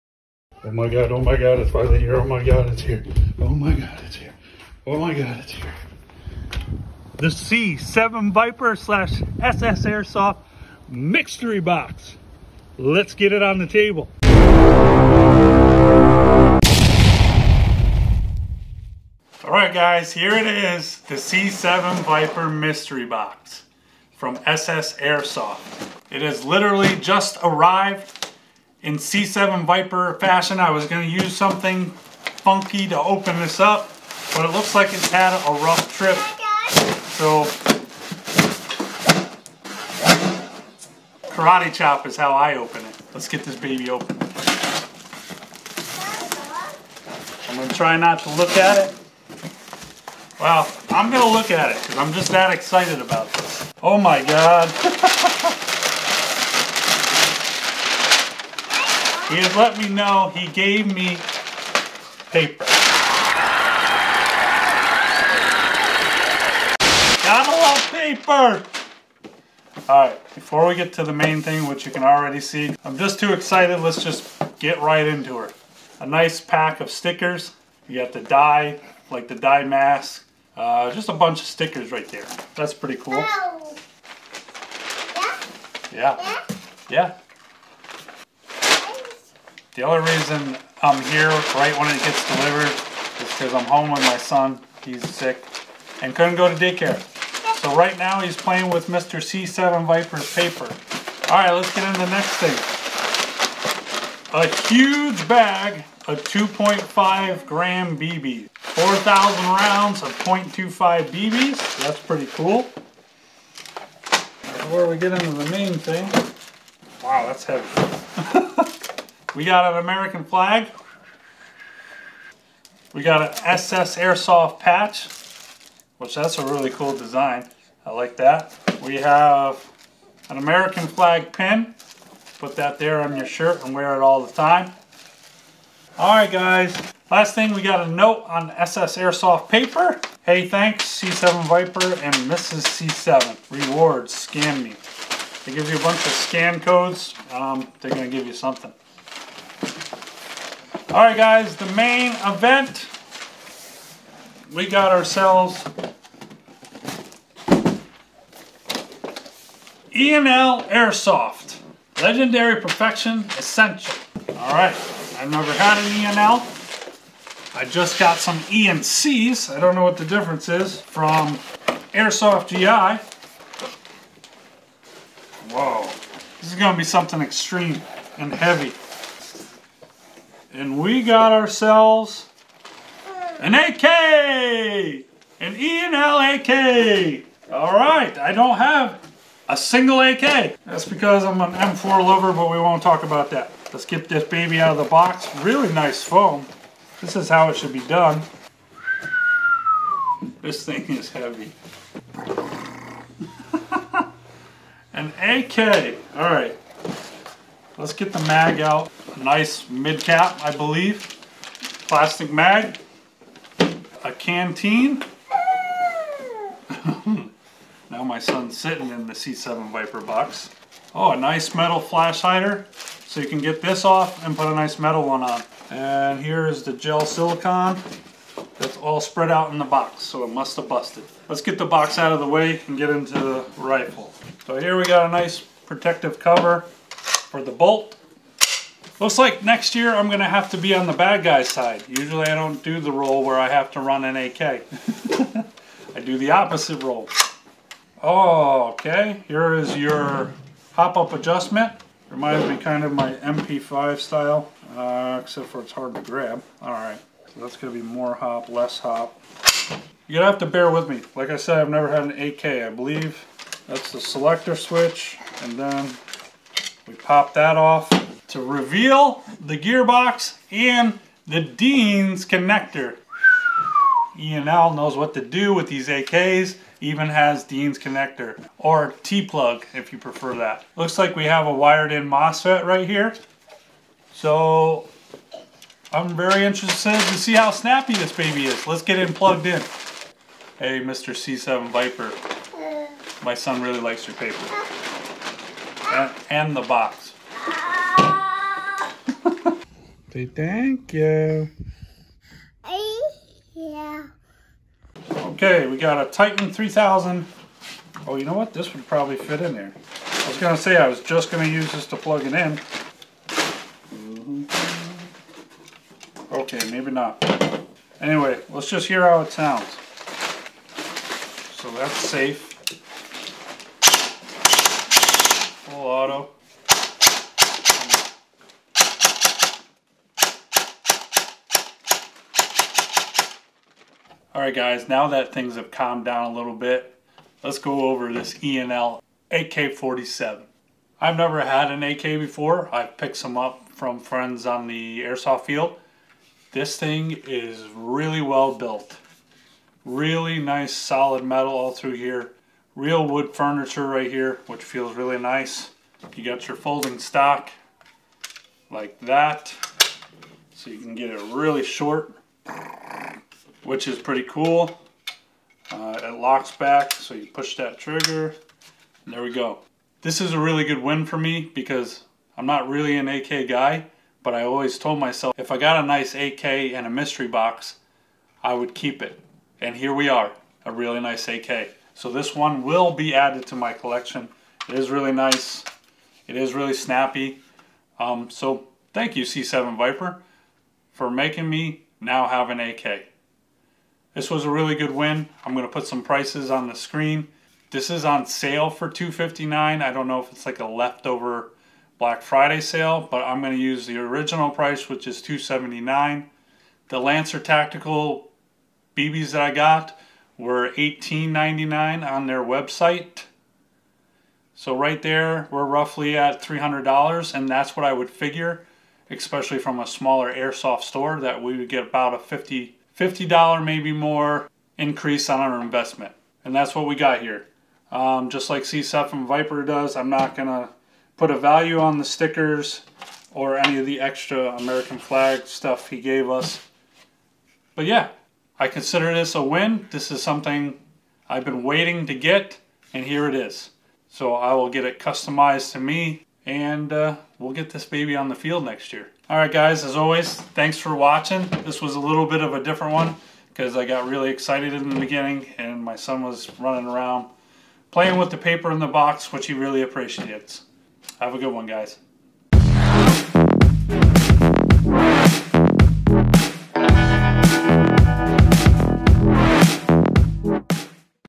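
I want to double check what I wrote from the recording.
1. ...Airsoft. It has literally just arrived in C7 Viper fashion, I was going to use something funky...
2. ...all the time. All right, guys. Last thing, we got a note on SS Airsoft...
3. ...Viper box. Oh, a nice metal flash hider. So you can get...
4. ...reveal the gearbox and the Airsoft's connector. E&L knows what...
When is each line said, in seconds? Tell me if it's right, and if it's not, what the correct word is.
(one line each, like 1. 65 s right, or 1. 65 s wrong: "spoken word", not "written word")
1. 24 s right
2. 134 s right
3. 219 s right
4. 268 s wrong: "Dean", not "Airsoft".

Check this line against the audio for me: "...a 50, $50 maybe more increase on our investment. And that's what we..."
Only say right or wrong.
right.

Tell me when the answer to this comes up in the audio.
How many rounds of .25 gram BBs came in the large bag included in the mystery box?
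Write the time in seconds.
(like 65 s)
108 s.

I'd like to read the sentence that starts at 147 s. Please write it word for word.
Um, they're going to give you something.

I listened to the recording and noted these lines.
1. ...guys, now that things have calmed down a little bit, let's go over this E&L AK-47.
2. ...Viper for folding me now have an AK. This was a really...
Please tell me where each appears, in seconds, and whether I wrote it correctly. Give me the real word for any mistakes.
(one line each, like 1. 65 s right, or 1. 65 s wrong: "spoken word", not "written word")
1. 334 s right
2. 389 s wrong: "making", not "folding".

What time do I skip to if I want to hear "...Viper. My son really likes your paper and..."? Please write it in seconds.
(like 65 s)
291 s.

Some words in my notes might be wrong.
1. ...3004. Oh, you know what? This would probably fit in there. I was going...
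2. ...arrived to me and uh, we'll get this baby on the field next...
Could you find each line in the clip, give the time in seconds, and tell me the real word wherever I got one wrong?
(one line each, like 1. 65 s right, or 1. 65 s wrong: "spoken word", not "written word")
1. 306 s wrong: "3000", not "3004"
2. 444 s wrong: "customized", not "arrived".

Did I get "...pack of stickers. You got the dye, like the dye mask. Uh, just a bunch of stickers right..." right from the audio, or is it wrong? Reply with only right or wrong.
right.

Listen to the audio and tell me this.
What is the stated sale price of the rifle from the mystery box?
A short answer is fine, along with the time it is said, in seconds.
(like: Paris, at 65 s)
$259, at 398 s.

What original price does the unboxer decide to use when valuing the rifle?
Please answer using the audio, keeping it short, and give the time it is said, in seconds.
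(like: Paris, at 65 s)
$279, at 405 s.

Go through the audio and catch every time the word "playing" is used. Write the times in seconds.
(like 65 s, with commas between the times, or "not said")
98 s, 457 s.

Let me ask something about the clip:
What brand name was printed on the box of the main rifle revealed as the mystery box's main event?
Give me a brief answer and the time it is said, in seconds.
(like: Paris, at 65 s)
E&L Airsoft, at 159 s.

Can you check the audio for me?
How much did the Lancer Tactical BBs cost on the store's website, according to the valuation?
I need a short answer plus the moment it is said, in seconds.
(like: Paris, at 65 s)
$18.99, at 410 s.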